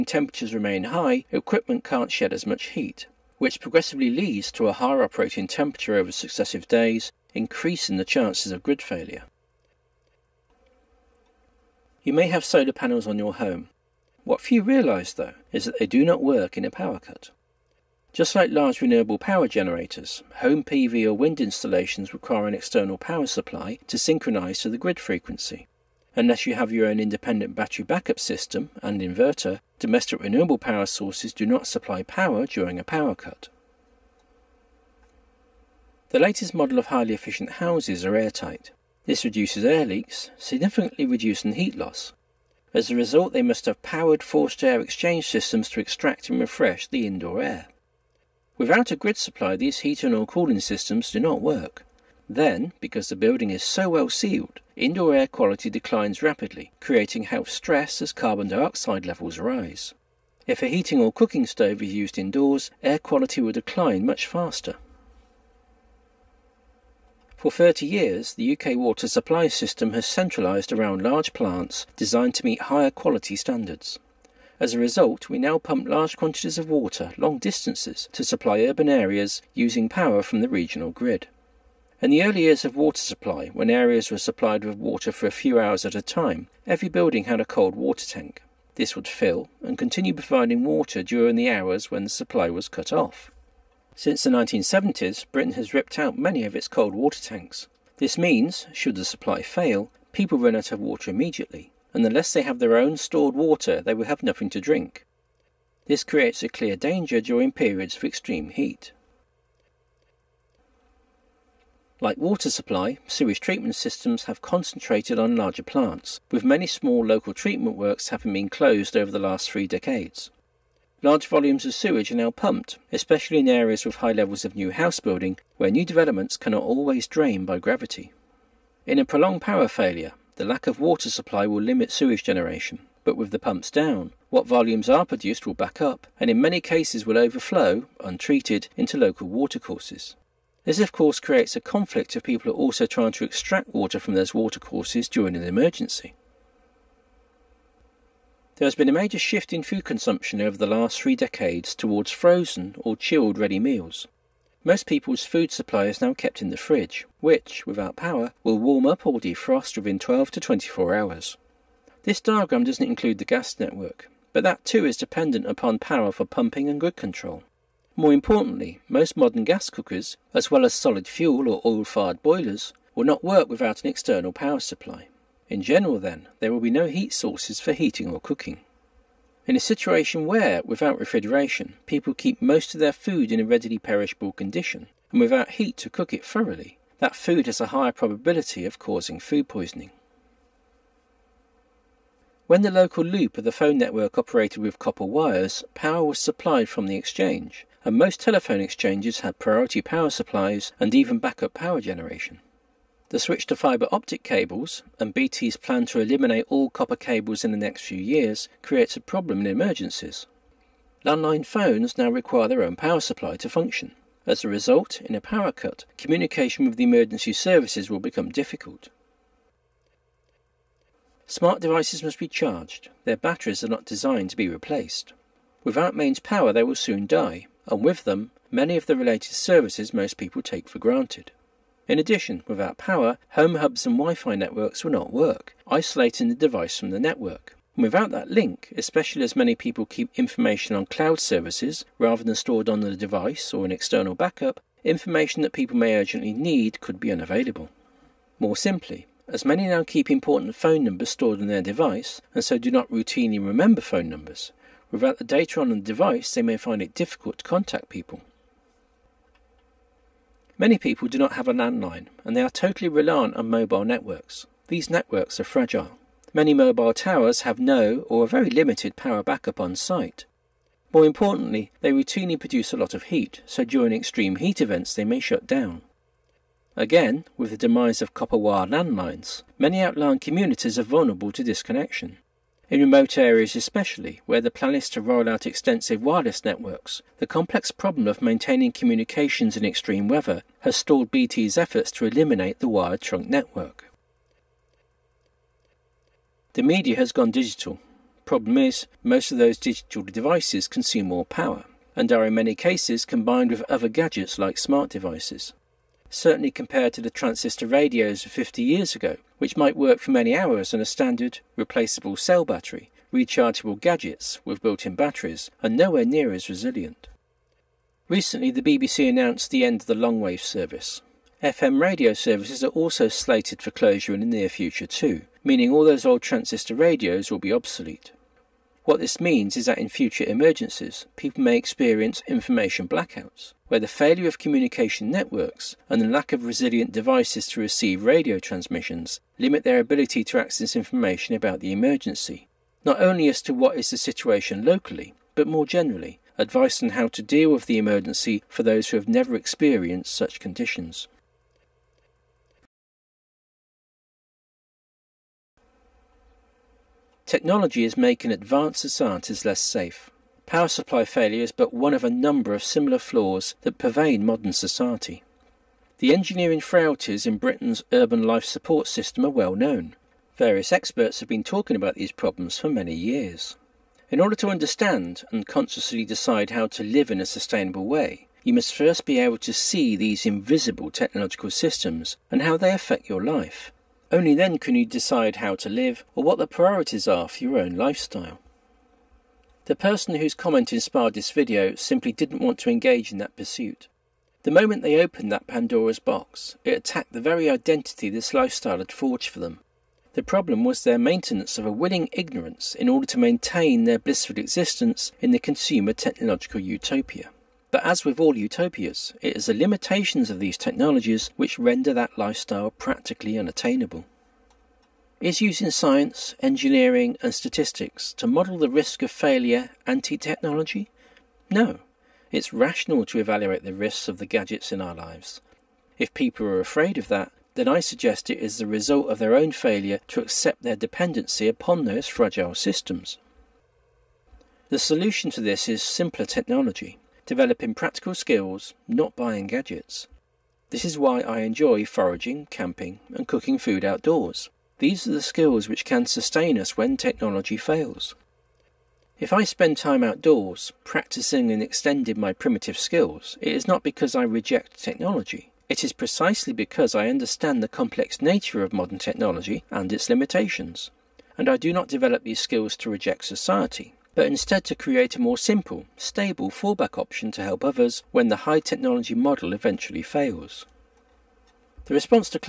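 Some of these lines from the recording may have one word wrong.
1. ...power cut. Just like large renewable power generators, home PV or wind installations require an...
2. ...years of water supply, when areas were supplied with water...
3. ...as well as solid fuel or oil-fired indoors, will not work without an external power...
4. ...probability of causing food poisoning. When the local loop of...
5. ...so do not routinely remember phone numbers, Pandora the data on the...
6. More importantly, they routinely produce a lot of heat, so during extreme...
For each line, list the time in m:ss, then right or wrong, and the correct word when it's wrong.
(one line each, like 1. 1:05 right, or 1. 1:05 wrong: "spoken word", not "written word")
1. 0:16 right
2. 1:22 right
3. 2:50 wrong: "boilers", not "indoors"
4. 3:07 right
5. 4:12 wrong: "Without", not "Pandora"
6. 4:30 right.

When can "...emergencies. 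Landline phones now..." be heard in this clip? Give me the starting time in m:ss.
3:29.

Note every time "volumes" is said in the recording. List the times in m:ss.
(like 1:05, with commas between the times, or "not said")
2:01, 2:14.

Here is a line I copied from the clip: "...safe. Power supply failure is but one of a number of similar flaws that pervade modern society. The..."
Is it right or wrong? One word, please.
right.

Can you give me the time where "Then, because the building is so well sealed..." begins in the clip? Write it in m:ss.
0:52.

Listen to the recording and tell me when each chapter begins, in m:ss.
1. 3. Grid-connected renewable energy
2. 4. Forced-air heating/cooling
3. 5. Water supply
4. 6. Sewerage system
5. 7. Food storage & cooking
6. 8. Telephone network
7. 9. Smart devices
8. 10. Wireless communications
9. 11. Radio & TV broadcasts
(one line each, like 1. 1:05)
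1. 0:09
2. 0:33
3. 1:04
4. 1:48
5. 2:26
6. 3:09
7. 3:38
8. 4:17
9. 4:52.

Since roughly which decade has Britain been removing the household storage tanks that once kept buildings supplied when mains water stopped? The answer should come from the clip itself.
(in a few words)
1970s.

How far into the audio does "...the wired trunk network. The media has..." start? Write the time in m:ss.
4:52.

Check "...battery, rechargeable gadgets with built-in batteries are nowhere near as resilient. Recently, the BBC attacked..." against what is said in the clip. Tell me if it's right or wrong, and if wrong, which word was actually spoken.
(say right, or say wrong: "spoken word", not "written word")
wrong: "announced", not "attacked".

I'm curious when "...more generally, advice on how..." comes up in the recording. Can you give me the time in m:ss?
5:45.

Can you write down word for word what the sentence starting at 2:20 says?
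This, of course, creates a conflict if people are also trying to extract water from those watercourses during an emergency.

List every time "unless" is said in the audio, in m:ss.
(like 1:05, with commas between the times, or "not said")
0:26, 1:42.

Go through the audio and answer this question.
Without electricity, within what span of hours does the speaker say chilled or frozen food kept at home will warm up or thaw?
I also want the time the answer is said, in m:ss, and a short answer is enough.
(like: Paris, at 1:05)
12 to 24 hours, at 2:39.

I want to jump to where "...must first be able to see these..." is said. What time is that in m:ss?
6:18.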